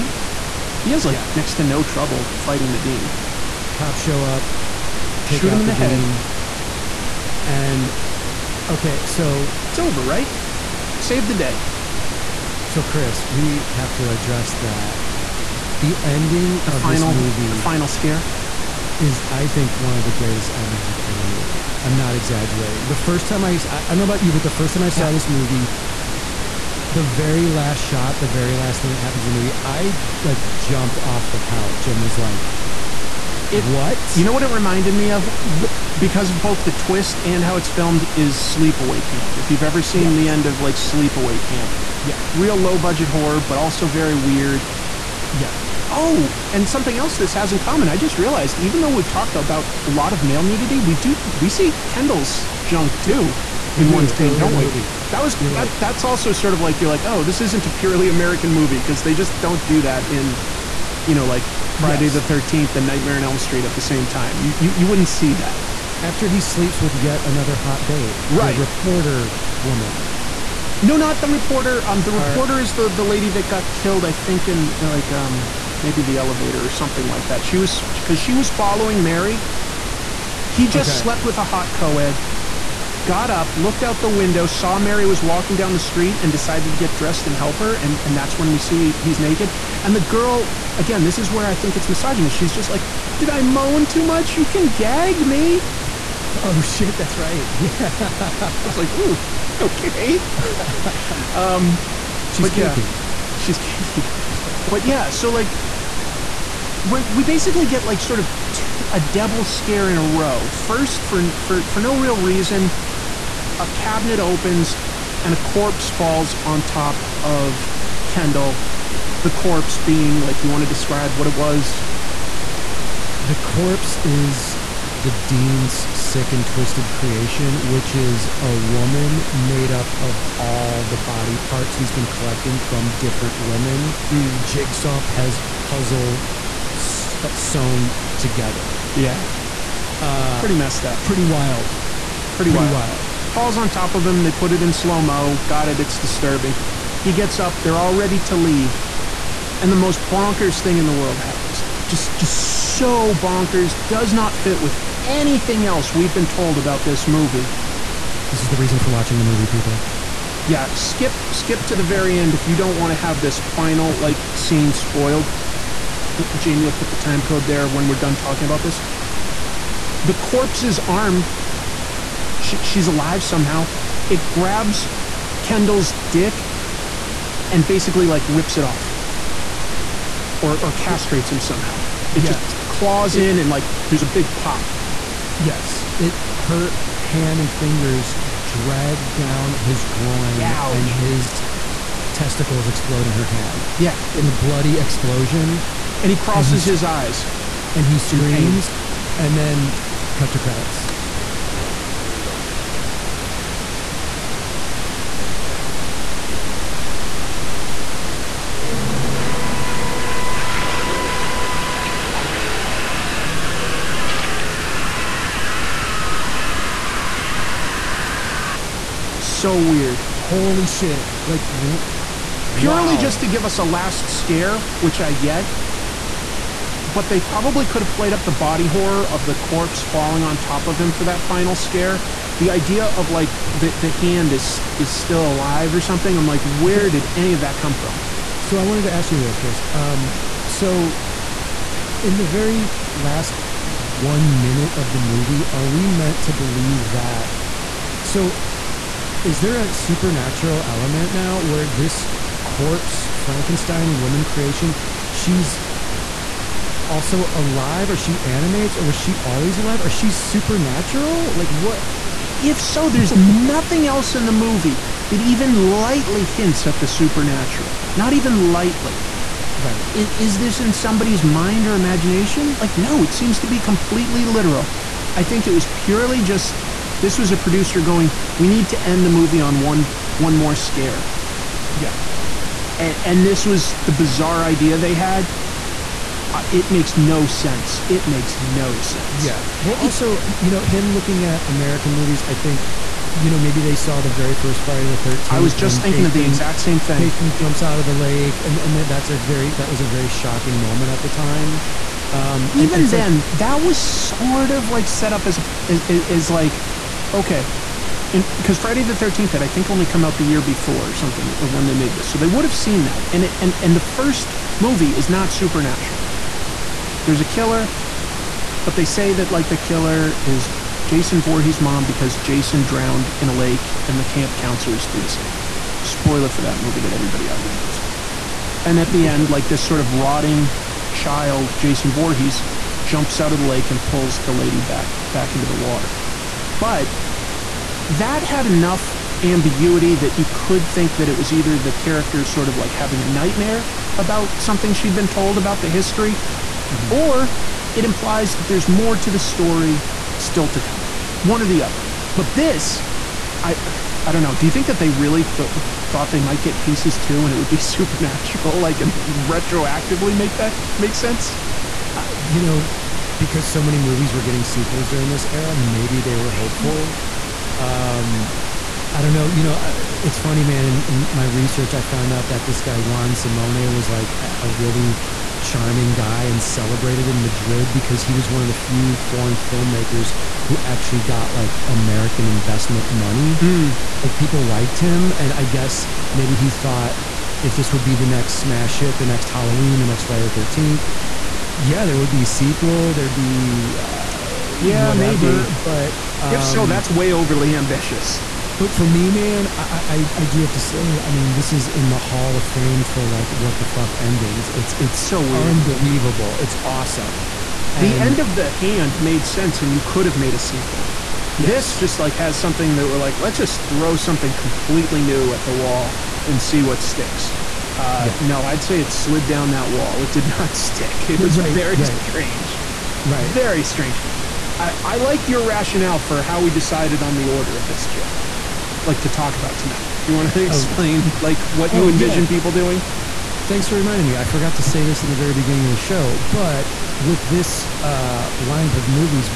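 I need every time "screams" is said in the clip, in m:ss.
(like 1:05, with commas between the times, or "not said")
3:17.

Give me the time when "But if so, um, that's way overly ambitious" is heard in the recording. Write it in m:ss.
6:35.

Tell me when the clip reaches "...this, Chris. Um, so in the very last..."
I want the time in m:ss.
3:59.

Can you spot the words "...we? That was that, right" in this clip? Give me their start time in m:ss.
0:54.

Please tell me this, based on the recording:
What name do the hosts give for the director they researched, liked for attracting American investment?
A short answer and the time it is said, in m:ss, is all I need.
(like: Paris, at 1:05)
Juan Simone, at 6:12.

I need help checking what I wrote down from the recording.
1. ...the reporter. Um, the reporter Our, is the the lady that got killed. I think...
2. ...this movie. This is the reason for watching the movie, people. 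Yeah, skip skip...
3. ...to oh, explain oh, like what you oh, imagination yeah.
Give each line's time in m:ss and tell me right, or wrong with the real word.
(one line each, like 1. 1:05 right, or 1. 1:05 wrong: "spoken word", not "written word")
1. 1:11 right
2. 2:36 right
3. 7:10 wrong: "envision", not "imagination".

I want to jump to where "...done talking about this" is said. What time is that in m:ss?
2:47.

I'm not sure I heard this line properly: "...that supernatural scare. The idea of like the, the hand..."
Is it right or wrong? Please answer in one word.
wrong.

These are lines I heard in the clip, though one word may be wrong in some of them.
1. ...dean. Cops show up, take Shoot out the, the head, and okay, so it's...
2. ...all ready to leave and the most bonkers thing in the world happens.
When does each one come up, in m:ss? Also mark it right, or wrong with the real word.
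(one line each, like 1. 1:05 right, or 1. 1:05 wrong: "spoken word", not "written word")
1. 0:02 right
2. 2:27 right.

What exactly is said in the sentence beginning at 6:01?
Uh, you know, because so many movies were getting sequels during this era, maybe they were maybe.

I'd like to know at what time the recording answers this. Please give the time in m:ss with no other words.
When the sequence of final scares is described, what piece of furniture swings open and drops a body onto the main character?
1:53.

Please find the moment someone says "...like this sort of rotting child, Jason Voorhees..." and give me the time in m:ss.
5:29.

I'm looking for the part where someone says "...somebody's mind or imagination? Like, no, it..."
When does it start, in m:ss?
4:30.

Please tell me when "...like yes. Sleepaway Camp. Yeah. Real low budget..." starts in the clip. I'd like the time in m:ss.
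0:40.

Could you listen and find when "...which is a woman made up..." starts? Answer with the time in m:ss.
2:07.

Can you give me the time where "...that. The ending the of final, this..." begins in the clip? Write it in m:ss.
0:14.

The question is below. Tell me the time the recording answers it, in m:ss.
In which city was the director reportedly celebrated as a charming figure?
6:17.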